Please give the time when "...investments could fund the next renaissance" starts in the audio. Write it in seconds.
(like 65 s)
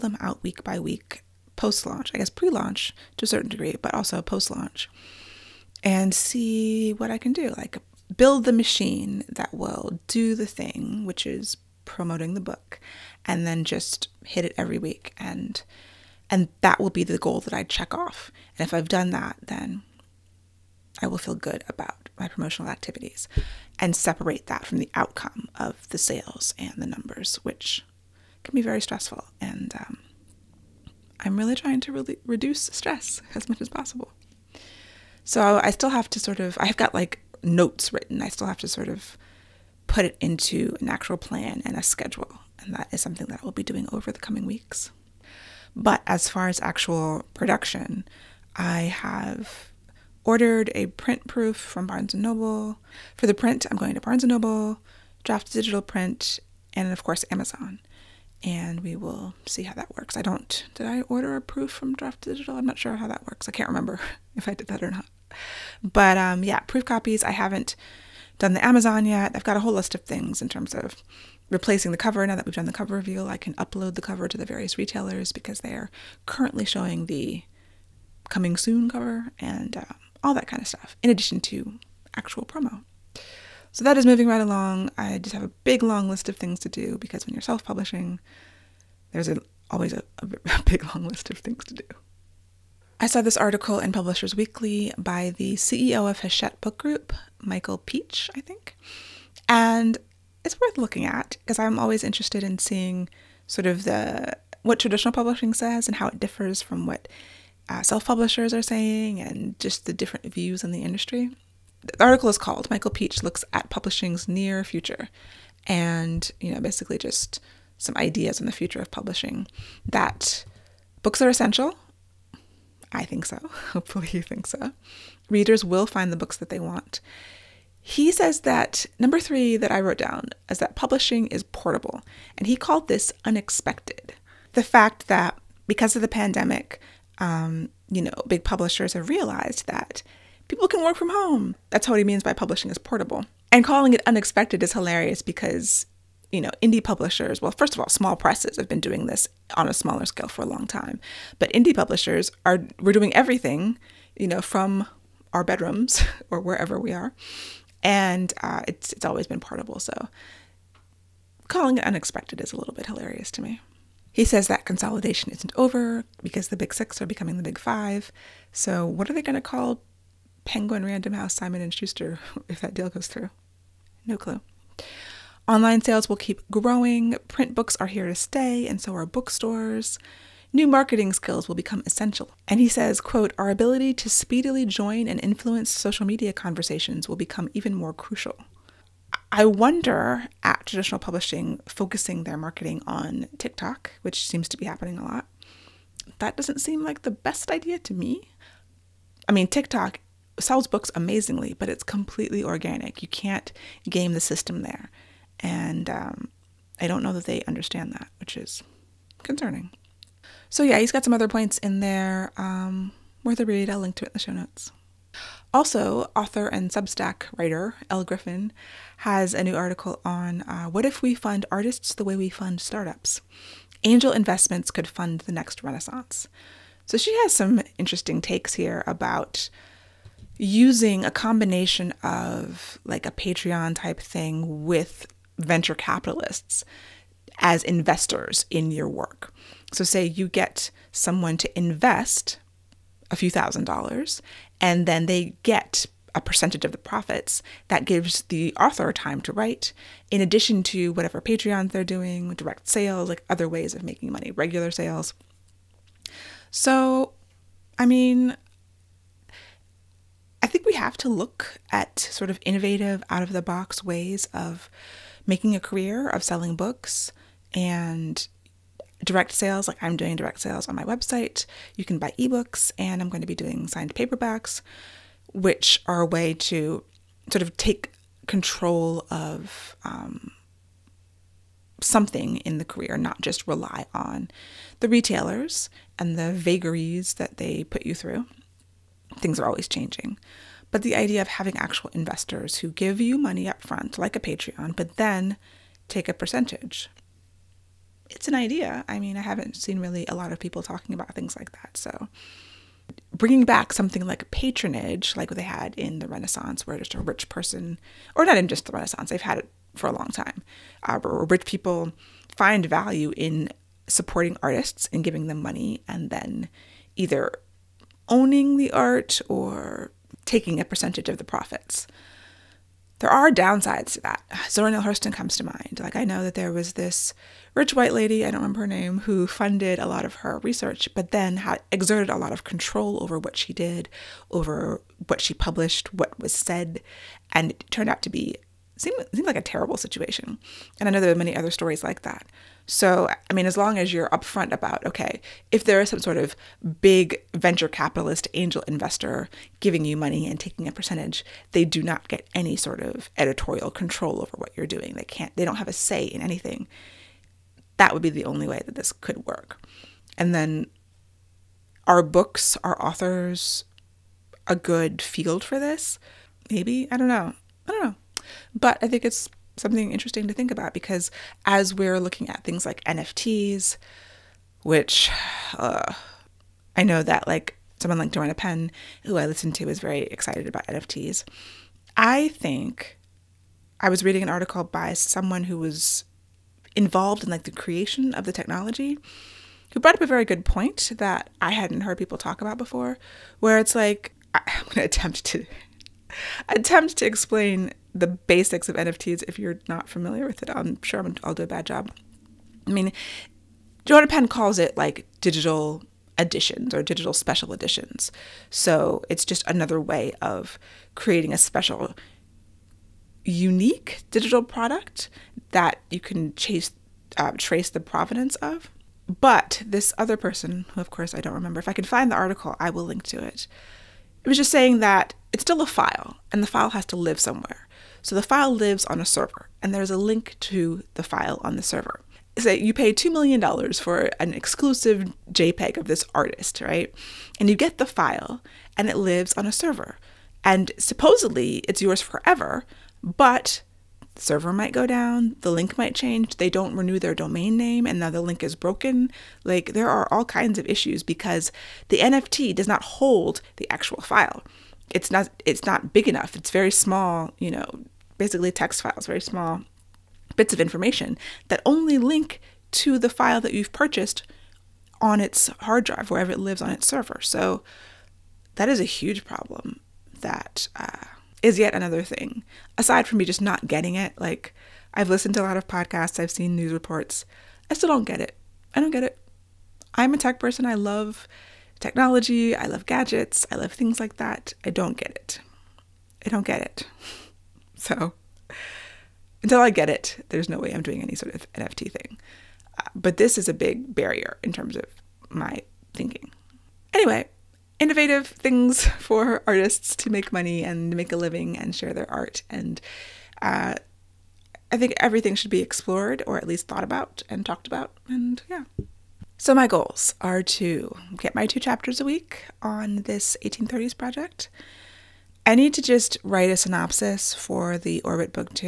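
224 s.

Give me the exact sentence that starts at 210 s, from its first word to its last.
So, yeah, he's got some other points in there um, worth a read.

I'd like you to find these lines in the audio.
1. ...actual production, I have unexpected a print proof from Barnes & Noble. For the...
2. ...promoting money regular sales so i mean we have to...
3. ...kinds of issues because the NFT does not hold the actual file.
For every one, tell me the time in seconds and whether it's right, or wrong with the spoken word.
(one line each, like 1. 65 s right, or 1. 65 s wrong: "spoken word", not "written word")
1. 46 s wrong: "ordered", not "unexpected"
2. 253 s wrong: "making", not "promoting"
3. 450 s right.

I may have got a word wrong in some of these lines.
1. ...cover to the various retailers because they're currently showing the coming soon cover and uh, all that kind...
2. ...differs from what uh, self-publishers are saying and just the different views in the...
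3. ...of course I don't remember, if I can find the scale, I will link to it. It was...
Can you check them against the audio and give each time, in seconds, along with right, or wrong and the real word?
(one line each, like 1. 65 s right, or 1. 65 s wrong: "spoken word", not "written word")
1. 74 s right
2. 106 s right
3. 420 s wrong: "article", not "scale".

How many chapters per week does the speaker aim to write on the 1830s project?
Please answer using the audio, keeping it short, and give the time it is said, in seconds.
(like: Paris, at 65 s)
2, at 511 s.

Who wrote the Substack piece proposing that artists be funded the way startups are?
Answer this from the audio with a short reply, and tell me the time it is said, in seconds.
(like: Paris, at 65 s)
Elle Griffin, at 217 s.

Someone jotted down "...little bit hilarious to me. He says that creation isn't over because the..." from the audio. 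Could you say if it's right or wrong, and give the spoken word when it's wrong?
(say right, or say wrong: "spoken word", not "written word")
wrong: "consolidation", not "creation".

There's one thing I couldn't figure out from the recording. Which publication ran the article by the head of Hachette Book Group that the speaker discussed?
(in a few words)
Publishers Weekly.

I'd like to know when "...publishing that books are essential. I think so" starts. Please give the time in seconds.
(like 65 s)
118 s.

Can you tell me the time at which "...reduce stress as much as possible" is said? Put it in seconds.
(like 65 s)
32 s.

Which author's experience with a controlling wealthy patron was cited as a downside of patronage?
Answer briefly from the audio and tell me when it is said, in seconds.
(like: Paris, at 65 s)
Zora Neale Hurston, at 324 s.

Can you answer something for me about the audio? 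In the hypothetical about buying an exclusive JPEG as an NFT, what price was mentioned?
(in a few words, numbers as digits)
$2 million.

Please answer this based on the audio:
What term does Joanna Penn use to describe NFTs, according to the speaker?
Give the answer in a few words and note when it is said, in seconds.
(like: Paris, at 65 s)
digital editions, at 405 s.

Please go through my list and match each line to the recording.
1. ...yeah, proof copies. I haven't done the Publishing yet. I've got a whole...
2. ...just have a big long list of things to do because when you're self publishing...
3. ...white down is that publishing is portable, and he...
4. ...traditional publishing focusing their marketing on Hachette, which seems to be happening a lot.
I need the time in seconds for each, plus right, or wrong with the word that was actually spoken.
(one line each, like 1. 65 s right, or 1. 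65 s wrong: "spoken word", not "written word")
1. 66 s wrong: "Amazon", not "Publishing"
2. 85 s right
3. 129 s wrong: "wrote", not "white"
4. 190 s wrong: "TikTok", not "Hachette".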